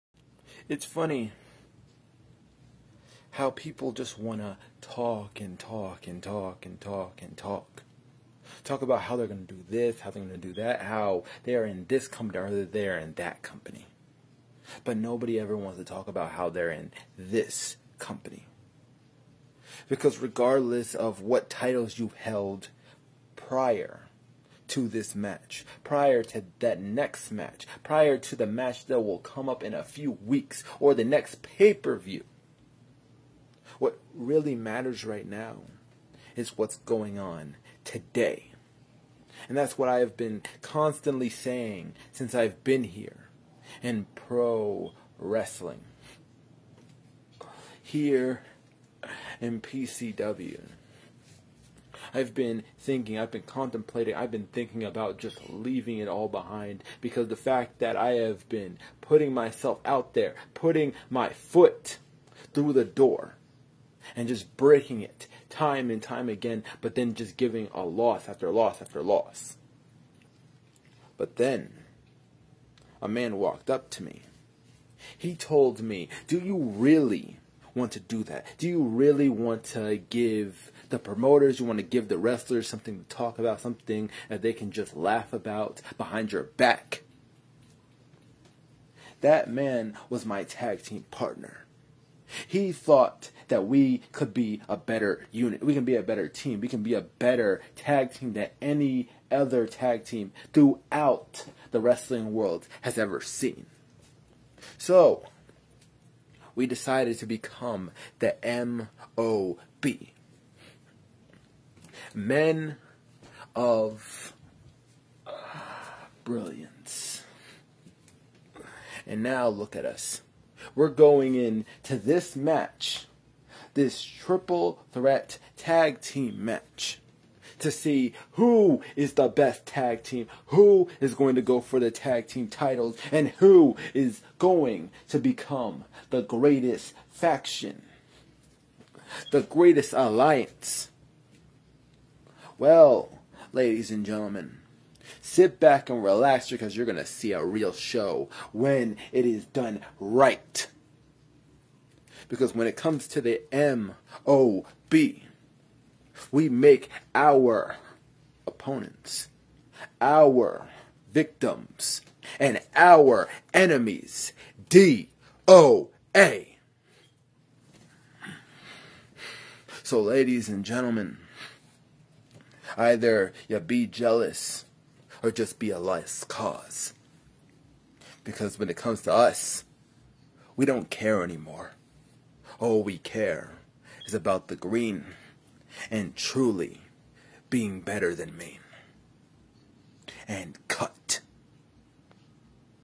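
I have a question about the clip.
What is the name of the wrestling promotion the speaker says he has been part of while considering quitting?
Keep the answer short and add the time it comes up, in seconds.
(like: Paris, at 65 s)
PCW, at 49 s.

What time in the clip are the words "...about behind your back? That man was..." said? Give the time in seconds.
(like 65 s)
85 s.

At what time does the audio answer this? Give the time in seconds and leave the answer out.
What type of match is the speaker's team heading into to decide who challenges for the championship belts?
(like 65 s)
124 s.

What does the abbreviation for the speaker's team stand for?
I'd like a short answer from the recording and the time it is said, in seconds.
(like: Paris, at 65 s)
Men of Brilliance, at 112 s.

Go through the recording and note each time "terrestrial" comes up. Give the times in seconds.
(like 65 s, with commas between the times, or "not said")
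not said.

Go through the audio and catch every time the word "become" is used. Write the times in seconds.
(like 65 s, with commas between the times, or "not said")
107 s, 135 s.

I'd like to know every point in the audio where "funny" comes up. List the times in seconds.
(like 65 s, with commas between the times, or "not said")
0 s.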